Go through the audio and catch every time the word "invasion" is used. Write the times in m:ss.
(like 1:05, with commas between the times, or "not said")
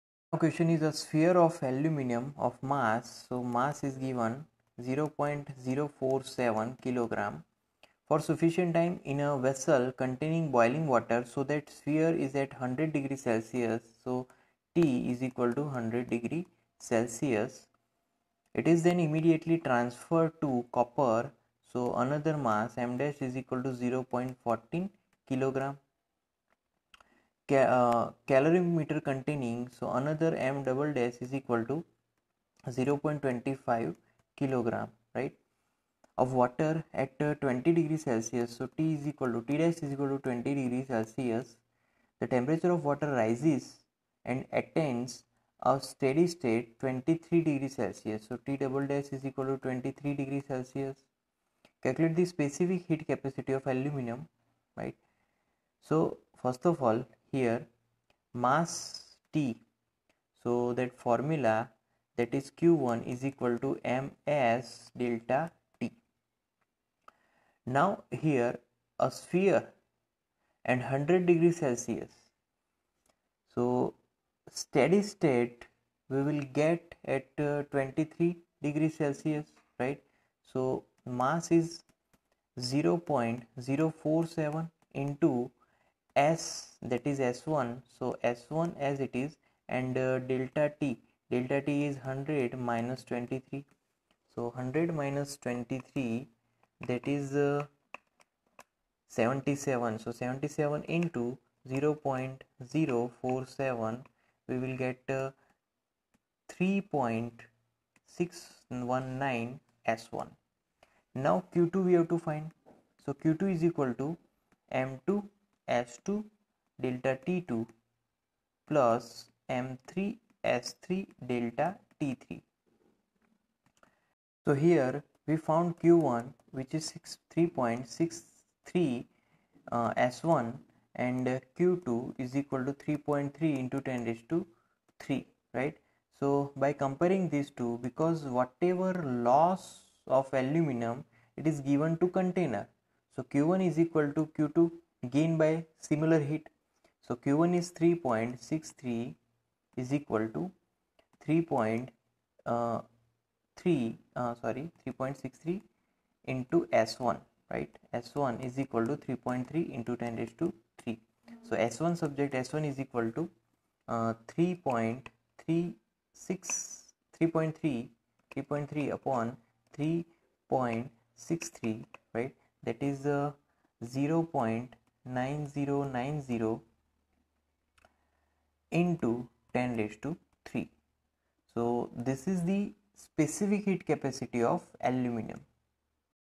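not said.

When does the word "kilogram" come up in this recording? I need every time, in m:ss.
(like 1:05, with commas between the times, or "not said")
0:06, 0:25, 0:34.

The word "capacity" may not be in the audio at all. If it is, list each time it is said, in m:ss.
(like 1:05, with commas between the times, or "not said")
0:53, 3:03.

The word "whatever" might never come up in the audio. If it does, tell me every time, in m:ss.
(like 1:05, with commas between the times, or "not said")
2:18.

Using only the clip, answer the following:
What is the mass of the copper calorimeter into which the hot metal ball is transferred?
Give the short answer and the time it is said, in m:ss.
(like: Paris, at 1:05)
0.14 kg, at 0:23.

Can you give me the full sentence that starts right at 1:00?
So that formula that is Q1 is equal to MS delta T.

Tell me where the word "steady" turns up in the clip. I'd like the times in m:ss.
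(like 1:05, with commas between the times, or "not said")
0:45, 1:14.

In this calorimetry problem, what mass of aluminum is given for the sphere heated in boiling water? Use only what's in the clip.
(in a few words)
0.047 kg.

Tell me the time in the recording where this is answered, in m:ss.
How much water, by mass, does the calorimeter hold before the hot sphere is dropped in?
0:32.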